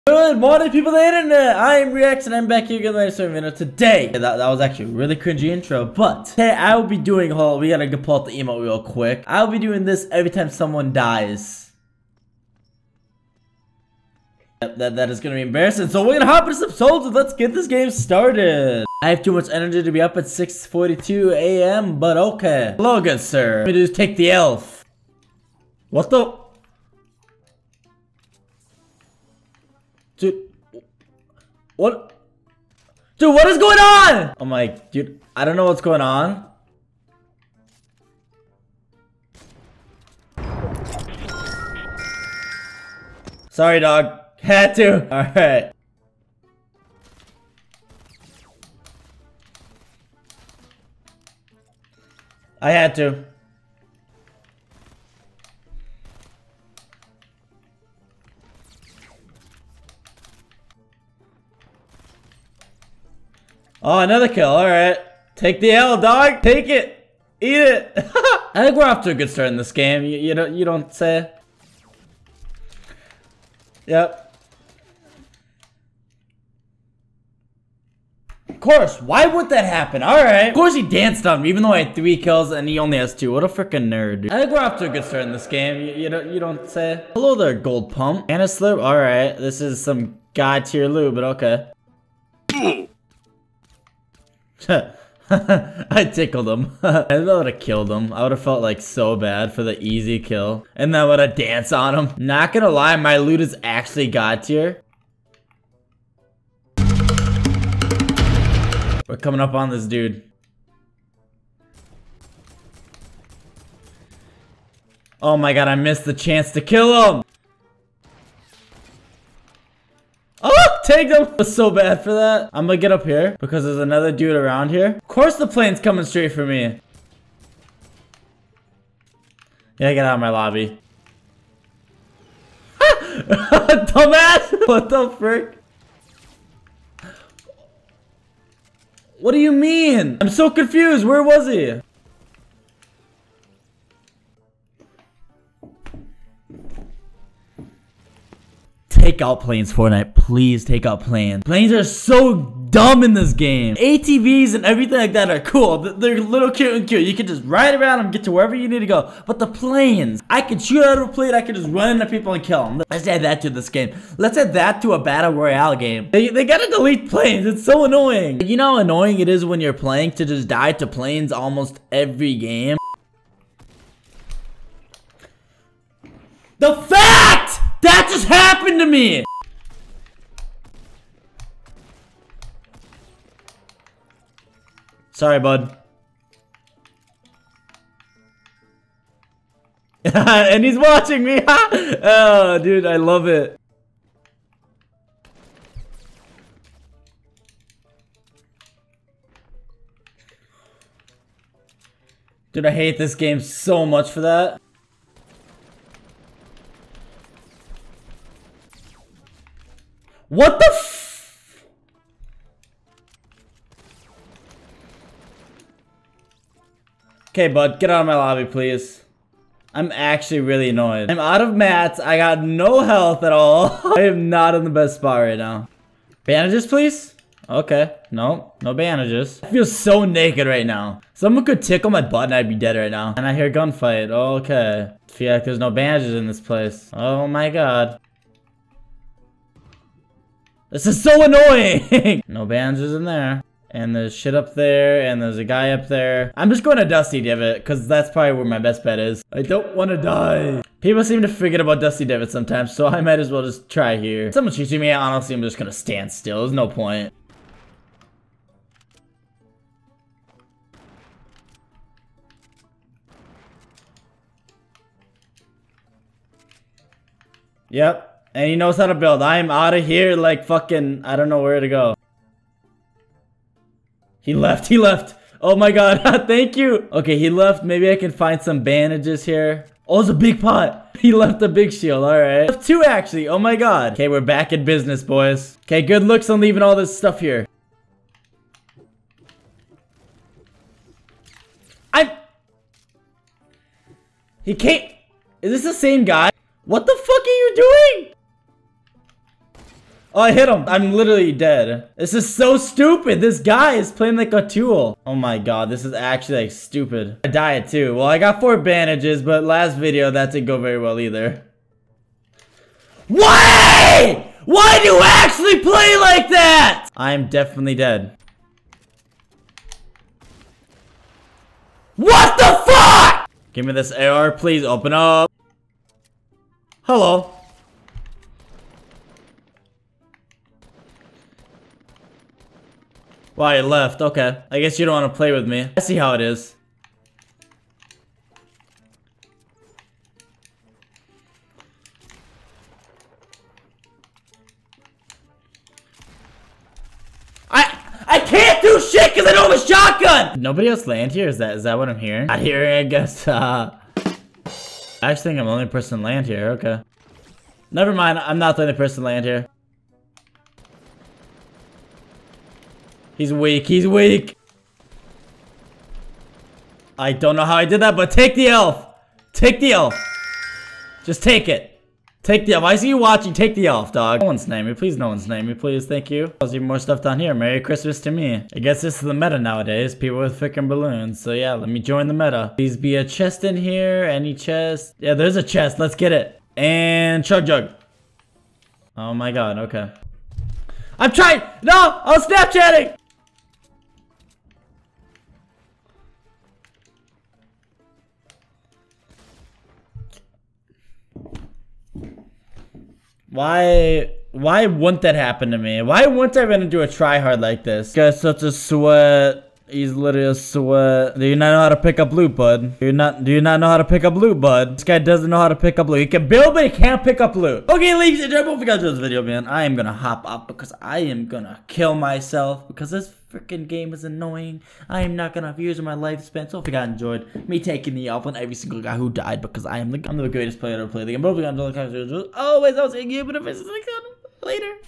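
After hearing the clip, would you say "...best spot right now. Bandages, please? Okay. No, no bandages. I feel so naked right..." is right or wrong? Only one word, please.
right.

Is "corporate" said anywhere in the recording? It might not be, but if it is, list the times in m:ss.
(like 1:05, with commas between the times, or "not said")
not said.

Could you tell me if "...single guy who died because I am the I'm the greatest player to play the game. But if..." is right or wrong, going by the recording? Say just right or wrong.
right.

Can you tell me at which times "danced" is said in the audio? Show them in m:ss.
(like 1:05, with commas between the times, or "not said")
1:20, 1:41.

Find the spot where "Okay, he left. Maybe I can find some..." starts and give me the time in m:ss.
4:36.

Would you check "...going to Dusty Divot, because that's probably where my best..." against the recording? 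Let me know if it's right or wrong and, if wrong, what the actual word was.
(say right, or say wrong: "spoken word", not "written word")
right.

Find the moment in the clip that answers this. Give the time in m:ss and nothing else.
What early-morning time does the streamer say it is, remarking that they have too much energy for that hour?
0:20.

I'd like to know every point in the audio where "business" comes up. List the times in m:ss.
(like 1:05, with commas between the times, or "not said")
4:44.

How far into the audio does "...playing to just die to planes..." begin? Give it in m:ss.
2:49.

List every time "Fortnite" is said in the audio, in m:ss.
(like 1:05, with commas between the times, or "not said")
2:29.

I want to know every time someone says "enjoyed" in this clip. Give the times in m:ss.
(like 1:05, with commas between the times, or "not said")
7:06, 7:11.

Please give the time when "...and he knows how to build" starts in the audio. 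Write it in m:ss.
4:28.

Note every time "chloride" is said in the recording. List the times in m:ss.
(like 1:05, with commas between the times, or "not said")
not said.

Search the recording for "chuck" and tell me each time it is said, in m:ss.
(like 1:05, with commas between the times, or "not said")
not said.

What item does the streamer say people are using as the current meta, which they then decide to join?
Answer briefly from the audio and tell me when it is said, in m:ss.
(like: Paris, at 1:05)
Balloons, at 6:20.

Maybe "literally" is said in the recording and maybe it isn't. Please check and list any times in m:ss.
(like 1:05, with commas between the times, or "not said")
5:00, 6:49.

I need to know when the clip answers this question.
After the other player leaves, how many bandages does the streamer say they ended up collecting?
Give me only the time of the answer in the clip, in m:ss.
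5:08.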